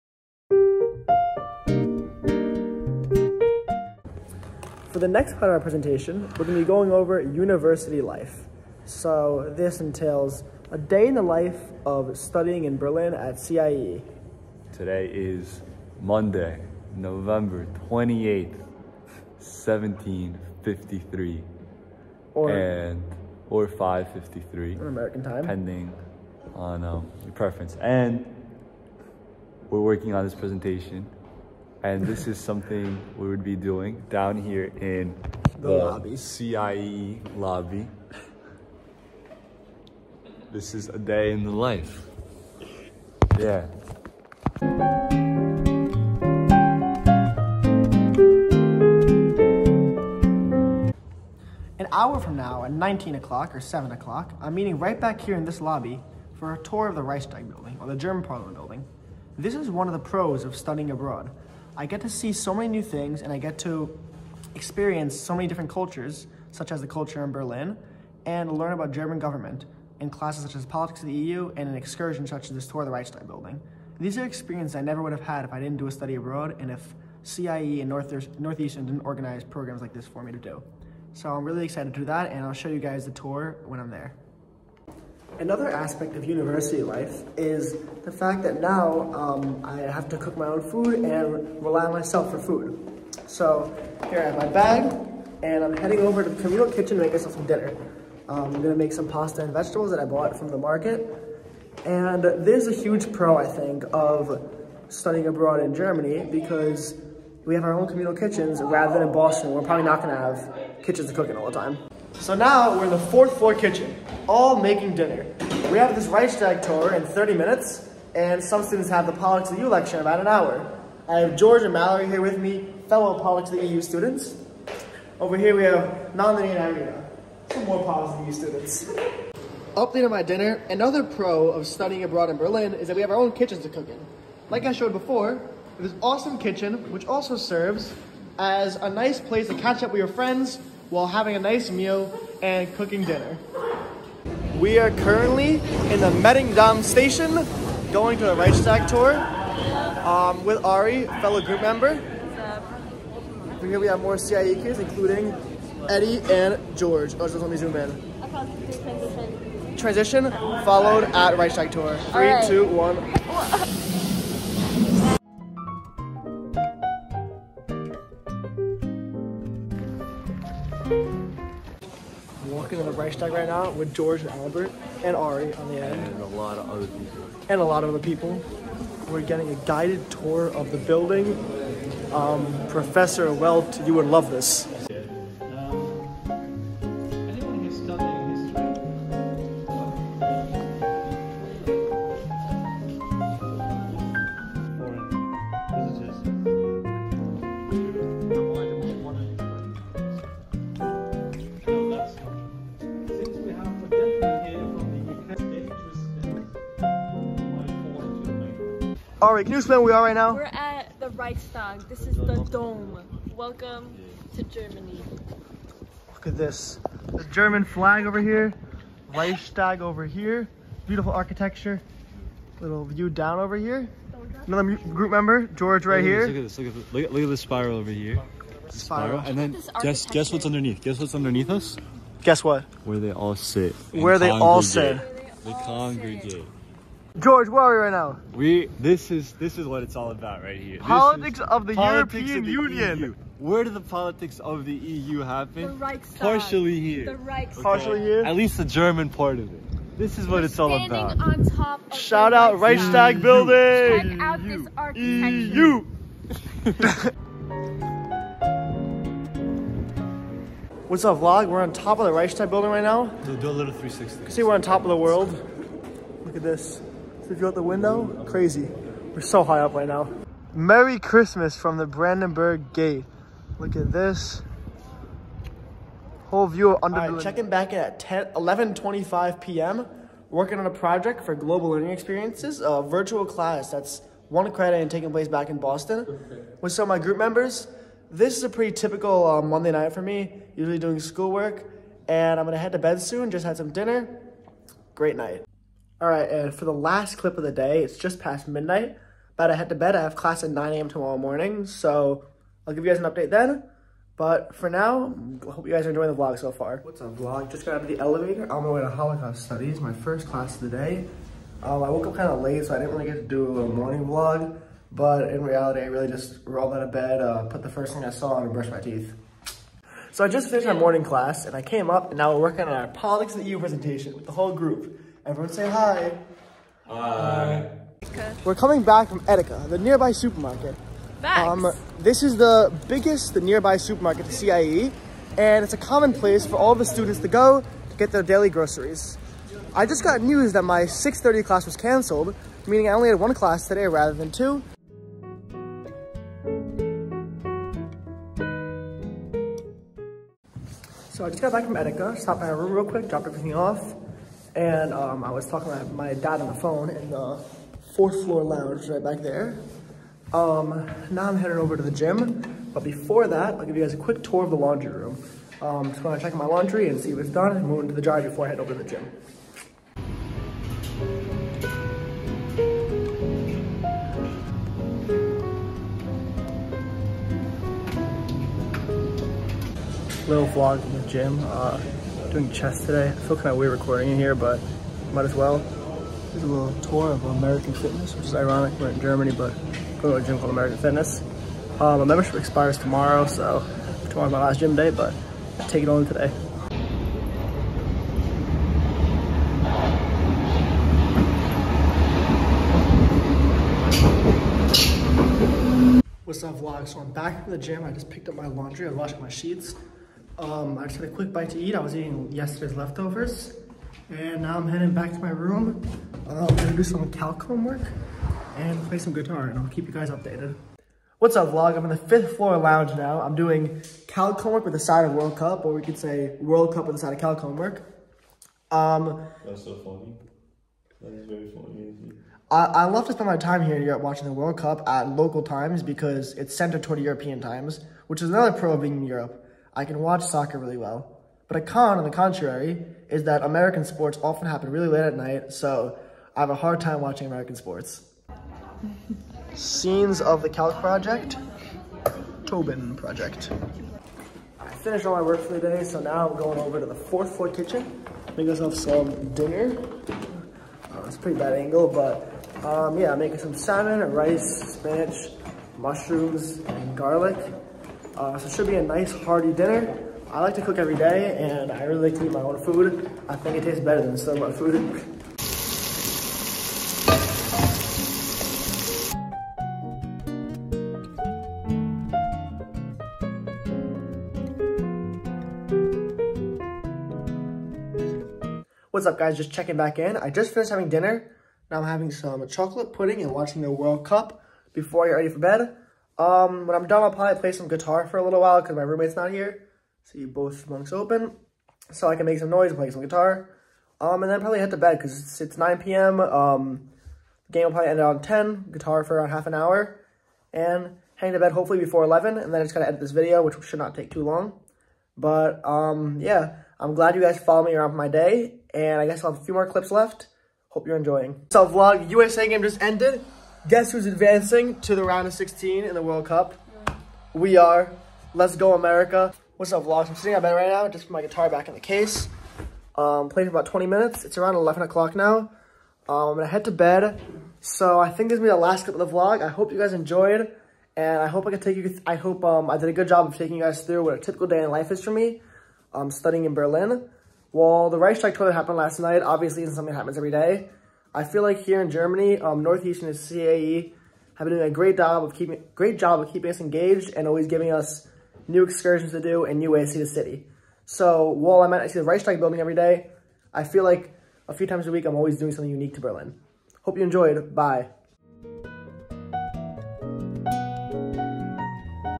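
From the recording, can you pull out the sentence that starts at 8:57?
So I think this is gonna be the last clip of the vlog.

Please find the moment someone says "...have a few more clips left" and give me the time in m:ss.
8:39.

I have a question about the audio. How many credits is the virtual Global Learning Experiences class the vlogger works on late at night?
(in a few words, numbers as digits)
1.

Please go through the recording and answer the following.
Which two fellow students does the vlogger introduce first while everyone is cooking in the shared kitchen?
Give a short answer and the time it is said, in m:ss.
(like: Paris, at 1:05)
George and Mallory, at 2:01.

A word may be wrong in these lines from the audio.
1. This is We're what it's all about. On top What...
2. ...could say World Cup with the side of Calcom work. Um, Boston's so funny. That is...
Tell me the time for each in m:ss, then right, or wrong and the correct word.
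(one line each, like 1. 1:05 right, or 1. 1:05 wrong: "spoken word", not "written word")
1. 4:09 wrong: "Shout", not "What"
2. 7:05 wrong: "That", not "Boston".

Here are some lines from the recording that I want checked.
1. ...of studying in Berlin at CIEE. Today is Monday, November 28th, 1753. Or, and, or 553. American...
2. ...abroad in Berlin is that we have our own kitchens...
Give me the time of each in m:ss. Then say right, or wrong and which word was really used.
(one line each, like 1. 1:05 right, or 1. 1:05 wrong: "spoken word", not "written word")
1. 0:11 right
2. 2:12 right.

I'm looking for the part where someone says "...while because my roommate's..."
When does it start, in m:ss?
8:18.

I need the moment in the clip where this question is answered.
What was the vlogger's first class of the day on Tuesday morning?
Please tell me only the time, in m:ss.
5:08.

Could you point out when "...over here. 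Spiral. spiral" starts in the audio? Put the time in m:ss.
3:47.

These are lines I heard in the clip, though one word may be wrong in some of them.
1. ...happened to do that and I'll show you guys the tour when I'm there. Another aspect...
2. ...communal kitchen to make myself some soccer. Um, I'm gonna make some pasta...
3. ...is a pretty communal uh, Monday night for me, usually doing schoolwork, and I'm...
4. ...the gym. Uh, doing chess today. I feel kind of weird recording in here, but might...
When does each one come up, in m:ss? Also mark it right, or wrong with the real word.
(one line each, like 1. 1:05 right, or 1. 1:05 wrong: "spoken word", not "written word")
1. 1:21 wrong: "excited", not "happened"
2. 1:36 wrong: "dinner", not "soccer"
3. 4:48 wrong: "typical", not "communal"
4. 6:21 right.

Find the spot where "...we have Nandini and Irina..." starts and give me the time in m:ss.
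2:05.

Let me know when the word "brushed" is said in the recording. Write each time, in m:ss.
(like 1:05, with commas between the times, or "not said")
5:18.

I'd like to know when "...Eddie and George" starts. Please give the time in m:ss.
2:35.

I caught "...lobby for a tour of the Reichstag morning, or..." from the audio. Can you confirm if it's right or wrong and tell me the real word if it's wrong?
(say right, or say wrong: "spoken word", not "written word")
wrong: "building", not "morning".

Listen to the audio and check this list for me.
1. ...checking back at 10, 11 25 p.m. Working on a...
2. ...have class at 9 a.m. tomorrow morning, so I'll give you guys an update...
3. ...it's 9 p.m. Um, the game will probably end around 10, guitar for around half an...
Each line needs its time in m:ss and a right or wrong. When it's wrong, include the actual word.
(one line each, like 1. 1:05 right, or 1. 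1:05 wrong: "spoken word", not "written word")
1. 4:37 right
2. 5:00 right
3. 8:25 right.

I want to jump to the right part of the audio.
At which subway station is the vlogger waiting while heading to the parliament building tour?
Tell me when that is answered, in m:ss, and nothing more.
2:26.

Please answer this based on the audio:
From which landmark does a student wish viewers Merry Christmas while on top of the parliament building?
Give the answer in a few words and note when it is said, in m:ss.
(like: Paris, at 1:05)
Brandenburg Gate, at 4:31.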